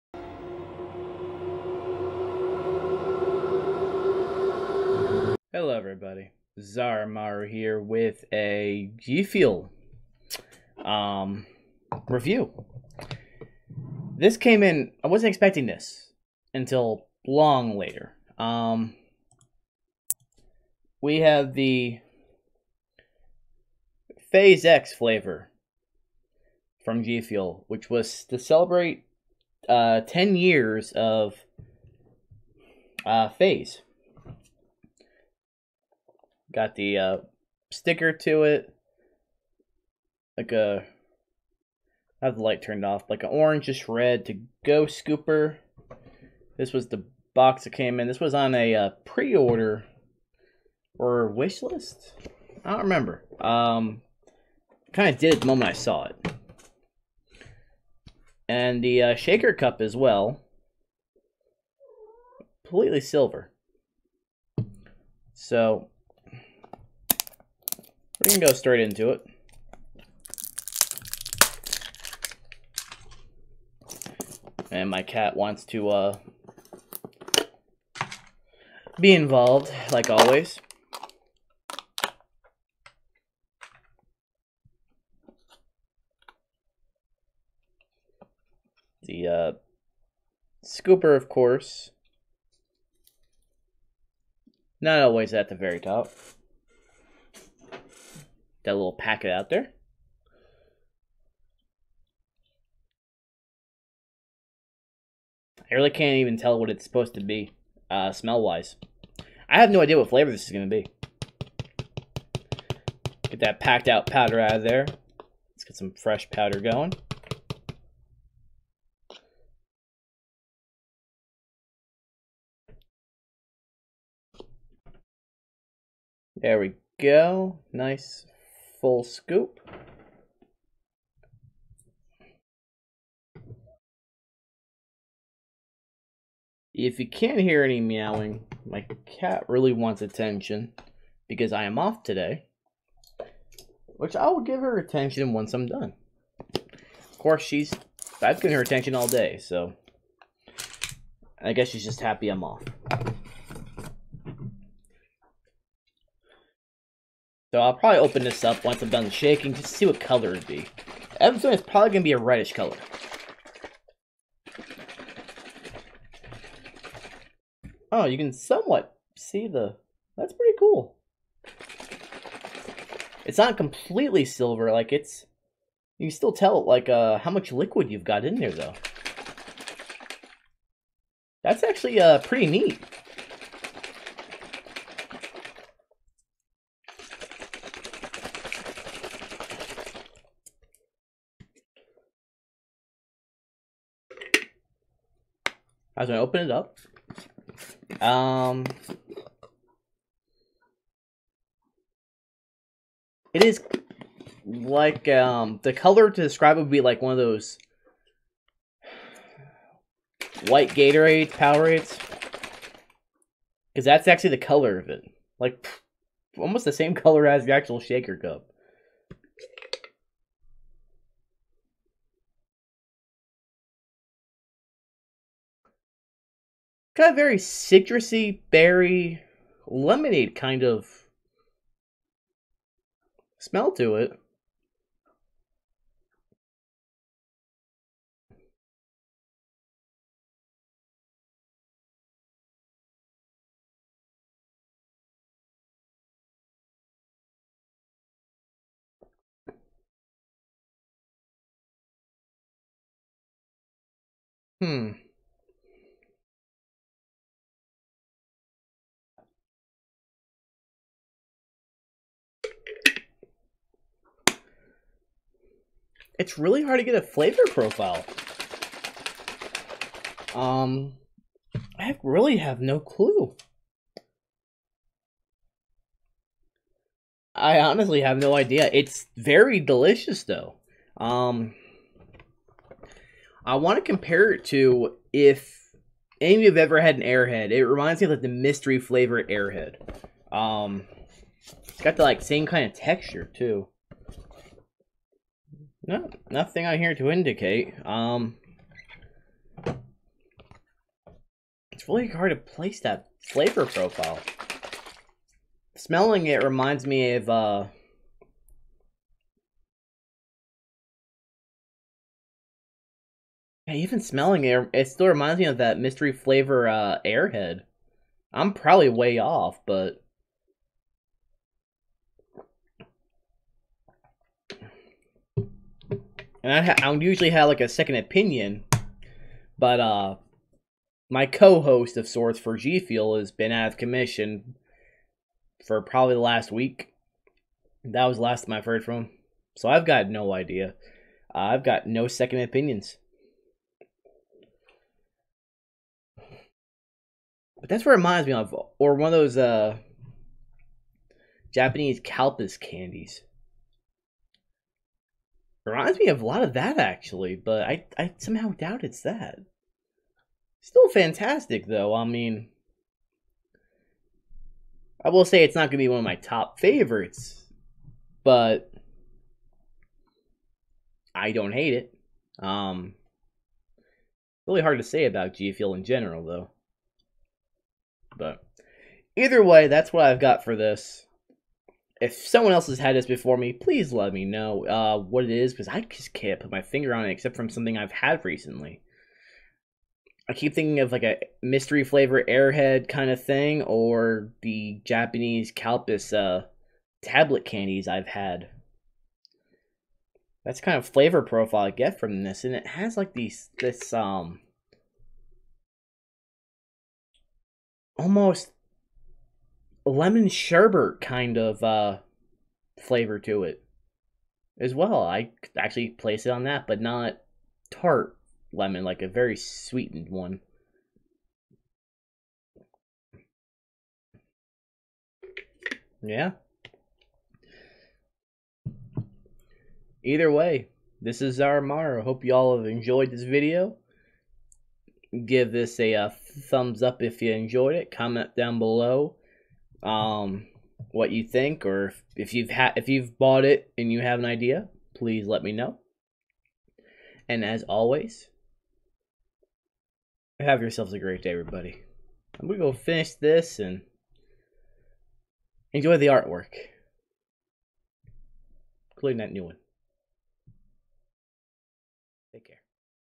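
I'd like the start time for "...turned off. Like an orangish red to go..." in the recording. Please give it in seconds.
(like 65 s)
42 s.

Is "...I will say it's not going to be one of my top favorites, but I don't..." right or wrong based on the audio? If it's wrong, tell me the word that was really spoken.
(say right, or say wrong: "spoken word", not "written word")
right.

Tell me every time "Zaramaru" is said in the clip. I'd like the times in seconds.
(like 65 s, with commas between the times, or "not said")
6 s, 431 s.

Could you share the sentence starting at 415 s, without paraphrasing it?
I actually place it on that, but not tart lemon, like a very sweetened one.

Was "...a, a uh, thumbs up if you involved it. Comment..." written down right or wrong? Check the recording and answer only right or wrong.
wrong.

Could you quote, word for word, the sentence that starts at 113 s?
Get that packed out powder out of there.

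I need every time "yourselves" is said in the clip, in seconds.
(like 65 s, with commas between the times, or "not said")
450 s.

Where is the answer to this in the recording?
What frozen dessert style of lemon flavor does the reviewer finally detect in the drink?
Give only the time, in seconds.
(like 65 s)
409 s.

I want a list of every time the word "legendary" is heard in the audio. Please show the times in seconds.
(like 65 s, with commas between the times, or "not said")
not said.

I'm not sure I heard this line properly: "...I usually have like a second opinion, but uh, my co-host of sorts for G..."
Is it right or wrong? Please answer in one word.
right.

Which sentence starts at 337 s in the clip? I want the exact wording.
That was the last time I've heard from him, so I've got no idea.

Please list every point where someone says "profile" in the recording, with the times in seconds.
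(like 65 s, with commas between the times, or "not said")
267 s, 303 s, 401 s.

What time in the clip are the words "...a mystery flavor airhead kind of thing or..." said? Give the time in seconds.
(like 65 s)
391 s.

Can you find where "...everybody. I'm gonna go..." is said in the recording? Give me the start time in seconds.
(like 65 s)
451 s.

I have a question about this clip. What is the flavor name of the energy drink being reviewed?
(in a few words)
FaZe X.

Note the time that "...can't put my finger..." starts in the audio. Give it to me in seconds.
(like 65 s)
386 s.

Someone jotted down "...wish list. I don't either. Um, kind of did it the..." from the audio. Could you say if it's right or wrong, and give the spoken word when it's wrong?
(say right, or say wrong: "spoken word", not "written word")
wrong: "remember", not "either".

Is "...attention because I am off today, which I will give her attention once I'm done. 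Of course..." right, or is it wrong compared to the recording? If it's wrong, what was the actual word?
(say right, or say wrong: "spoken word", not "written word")
right.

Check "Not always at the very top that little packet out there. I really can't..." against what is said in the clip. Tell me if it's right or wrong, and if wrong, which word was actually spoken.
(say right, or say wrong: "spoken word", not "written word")
right.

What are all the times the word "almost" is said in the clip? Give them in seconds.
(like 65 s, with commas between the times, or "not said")
216 s, 407 s.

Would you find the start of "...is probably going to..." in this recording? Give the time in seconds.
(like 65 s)
161 s.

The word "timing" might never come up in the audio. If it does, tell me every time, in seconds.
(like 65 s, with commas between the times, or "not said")
not said.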